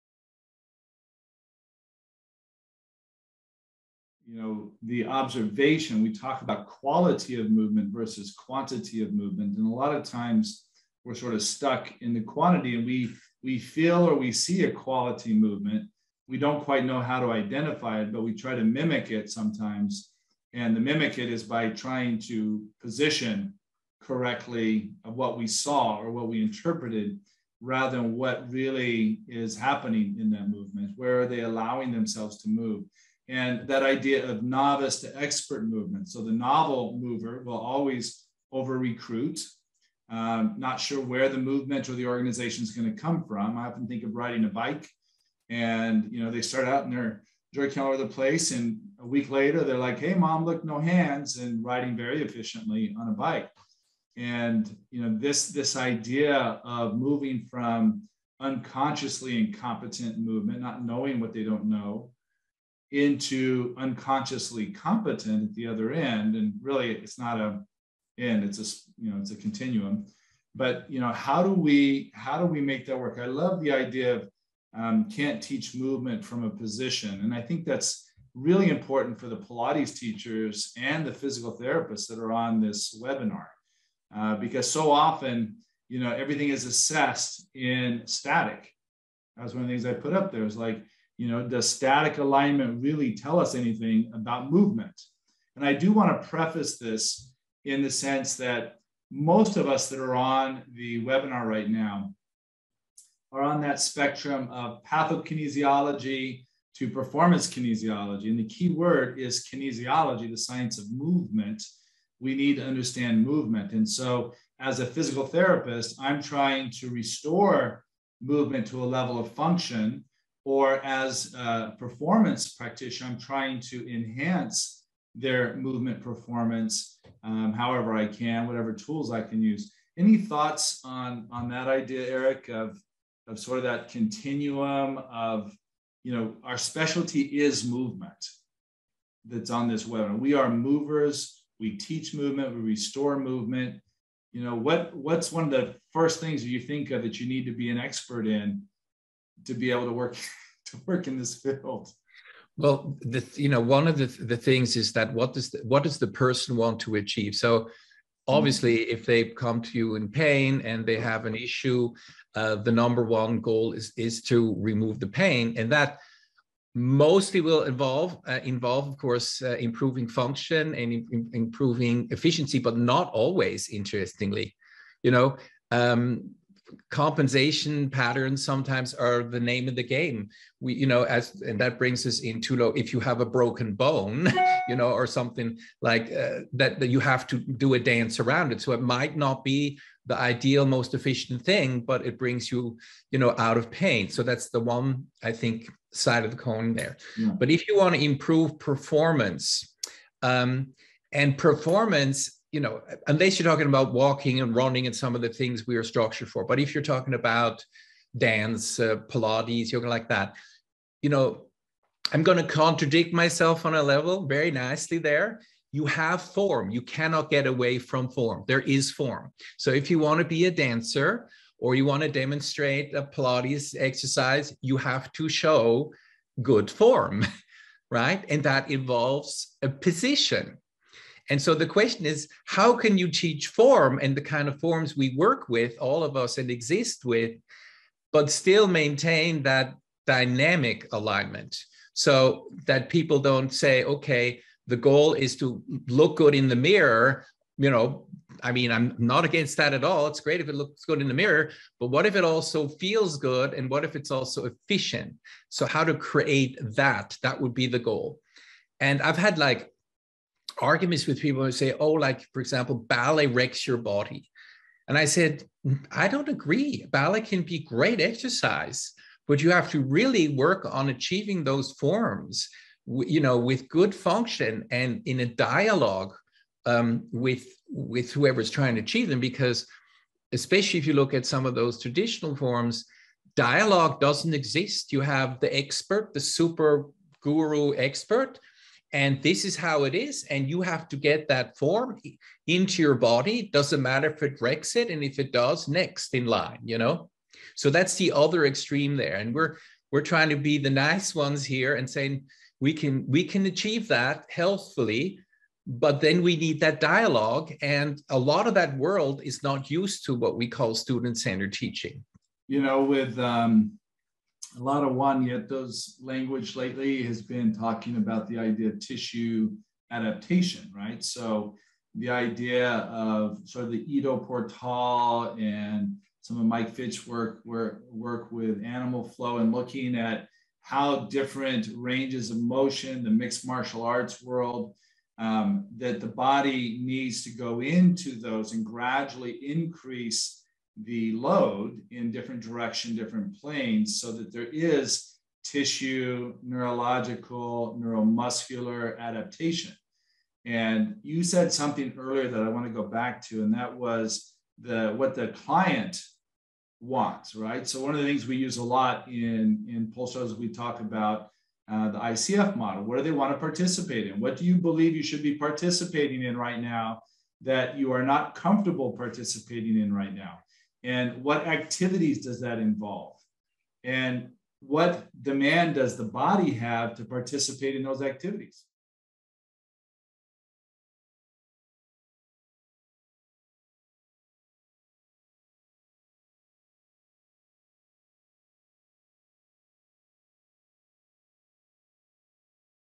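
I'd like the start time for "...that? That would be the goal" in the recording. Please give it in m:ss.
4:16.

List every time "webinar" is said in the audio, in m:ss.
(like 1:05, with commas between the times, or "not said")
1:23, 1:41, 2:19.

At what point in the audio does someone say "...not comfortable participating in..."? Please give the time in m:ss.
6:08.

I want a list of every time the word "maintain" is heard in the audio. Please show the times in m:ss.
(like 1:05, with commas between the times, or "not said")
3:58.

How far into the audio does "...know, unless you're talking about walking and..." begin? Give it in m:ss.
3:22.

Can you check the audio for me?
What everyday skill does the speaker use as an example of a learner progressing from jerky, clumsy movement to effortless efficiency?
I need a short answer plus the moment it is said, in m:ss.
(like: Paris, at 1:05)
Riding a bike, at 0:44.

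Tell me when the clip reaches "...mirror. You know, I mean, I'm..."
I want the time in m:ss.
4:06.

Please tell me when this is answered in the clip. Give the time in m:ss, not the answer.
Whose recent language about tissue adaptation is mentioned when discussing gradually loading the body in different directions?
5:14.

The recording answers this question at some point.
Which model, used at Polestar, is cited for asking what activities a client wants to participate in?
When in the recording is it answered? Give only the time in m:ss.
6:01.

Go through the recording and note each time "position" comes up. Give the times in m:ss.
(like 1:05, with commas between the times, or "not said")
0:22, 1:16, 3:49.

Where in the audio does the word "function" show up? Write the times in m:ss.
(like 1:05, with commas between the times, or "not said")
1:59, 2:50, 4:33.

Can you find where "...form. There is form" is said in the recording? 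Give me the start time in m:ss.
3:38.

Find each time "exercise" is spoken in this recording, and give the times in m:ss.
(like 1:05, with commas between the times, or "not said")
3:43, 4:28.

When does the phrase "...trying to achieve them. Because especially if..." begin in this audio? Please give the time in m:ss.
4:38.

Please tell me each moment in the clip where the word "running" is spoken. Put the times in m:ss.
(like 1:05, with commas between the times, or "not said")
3:24.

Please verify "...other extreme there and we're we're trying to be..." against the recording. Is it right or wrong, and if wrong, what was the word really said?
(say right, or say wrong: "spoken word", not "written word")
right.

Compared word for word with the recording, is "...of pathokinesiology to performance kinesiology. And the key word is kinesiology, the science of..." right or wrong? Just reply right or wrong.
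right.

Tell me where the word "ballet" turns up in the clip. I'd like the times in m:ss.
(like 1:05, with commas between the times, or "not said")
4:22, 4:26.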